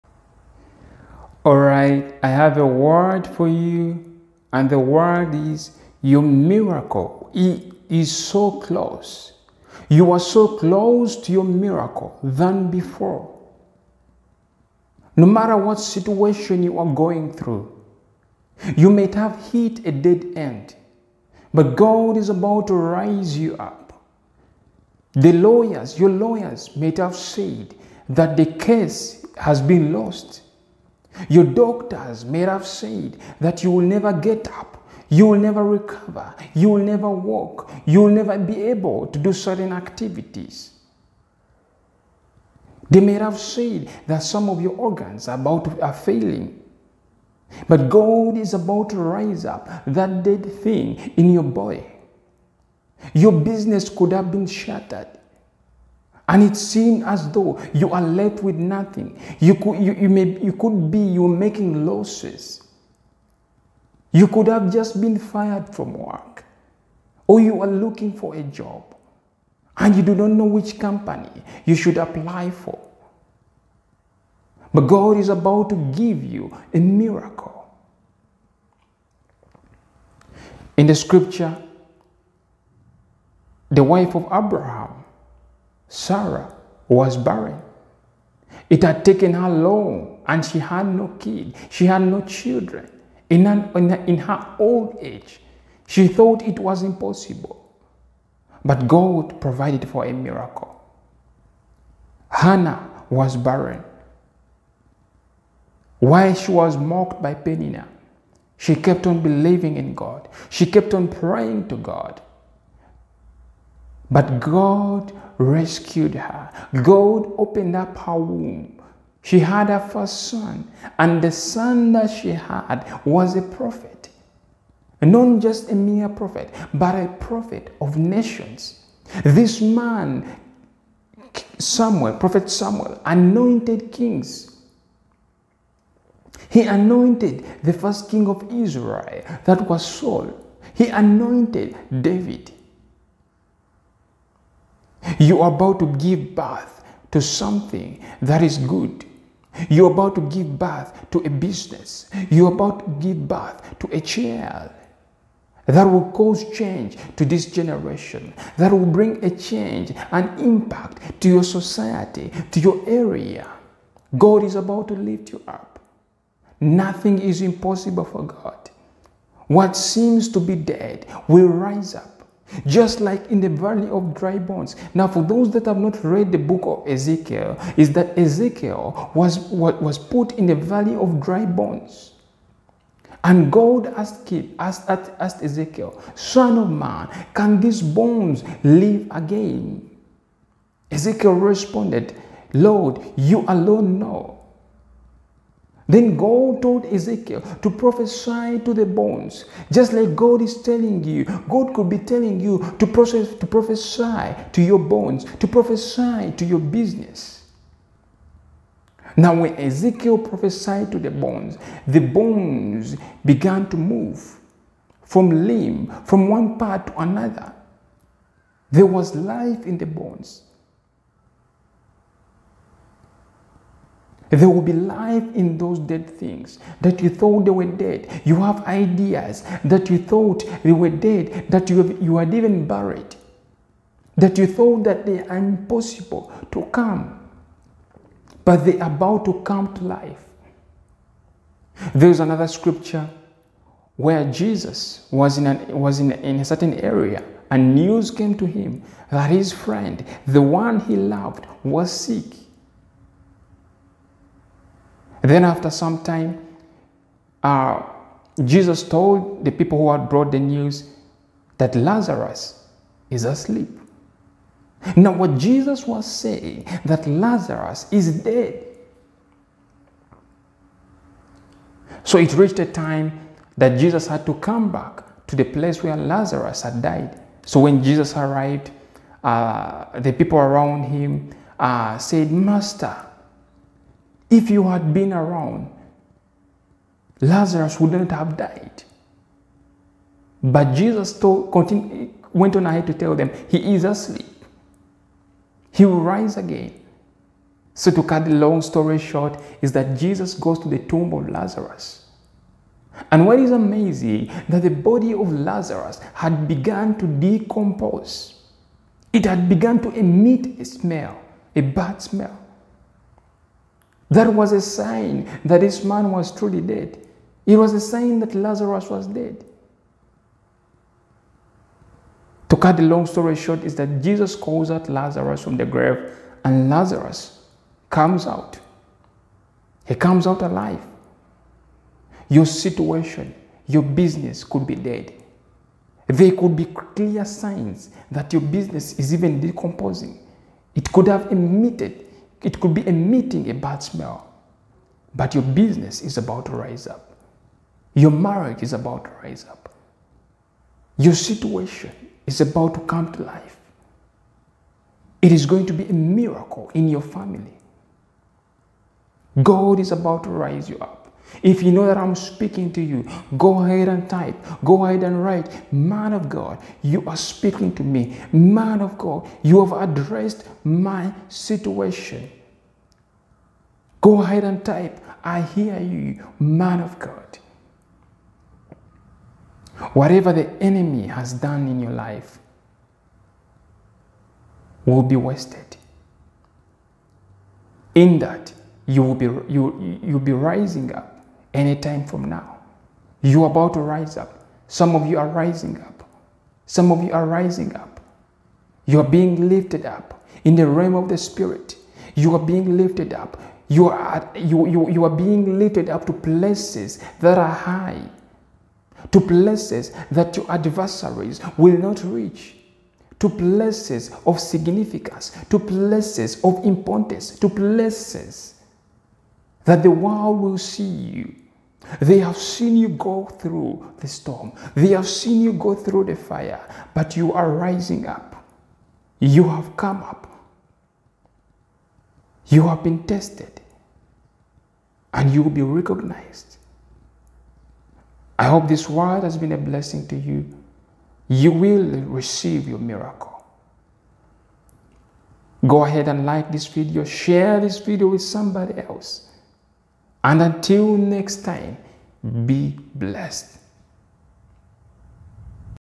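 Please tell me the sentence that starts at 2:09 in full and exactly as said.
This man, Samuel, Prophet Samuel, anointed kings.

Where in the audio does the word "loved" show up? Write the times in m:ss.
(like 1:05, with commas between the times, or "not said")
4:10.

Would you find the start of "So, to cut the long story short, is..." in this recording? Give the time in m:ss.
4:57.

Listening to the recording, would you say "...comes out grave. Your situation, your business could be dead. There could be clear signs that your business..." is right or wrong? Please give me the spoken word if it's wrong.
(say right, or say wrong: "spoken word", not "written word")
wrong: "alive", not "grave".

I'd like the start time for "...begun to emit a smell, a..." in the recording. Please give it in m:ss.
5:09.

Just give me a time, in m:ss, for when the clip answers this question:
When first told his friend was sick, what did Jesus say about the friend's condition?
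4:21.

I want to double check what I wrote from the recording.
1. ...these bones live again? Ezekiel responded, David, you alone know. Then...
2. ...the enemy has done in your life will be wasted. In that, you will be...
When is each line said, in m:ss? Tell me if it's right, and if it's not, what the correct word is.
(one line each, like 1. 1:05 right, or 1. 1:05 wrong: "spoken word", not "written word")
1. 3:07 wrong: "Lord", not "David"
2. 6:20 right.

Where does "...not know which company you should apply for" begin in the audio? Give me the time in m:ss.
1:10.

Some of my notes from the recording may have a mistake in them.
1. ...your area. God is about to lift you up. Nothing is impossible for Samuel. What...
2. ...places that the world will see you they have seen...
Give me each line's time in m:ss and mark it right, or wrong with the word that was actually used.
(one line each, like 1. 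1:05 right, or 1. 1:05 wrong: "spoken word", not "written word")
1. 2:42 wrong: "God", not "Samuel"
2. 6:57 right.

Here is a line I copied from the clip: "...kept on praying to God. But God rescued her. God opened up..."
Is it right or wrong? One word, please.
right.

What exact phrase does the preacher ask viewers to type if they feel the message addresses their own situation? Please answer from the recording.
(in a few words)
Man of God, you are speaking to me.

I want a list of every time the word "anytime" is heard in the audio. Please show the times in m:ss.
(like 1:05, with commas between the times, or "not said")
6:31.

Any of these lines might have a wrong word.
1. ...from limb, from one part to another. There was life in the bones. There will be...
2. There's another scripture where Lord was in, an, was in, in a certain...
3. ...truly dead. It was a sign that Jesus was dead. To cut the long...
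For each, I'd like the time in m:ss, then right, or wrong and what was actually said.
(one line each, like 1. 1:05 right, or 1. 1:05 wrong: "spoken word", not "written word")
1. 3:35 right
2. 4:01 wrong: "Jesus", not "Lord"
3. 5:16 wrong: "Lazarus", not "Jesus".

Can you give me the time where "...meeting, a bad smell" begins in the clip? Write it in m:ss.
5:42.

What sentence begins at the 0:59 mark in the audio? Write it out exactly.
You could, you, you, may, you could be, you're making losses.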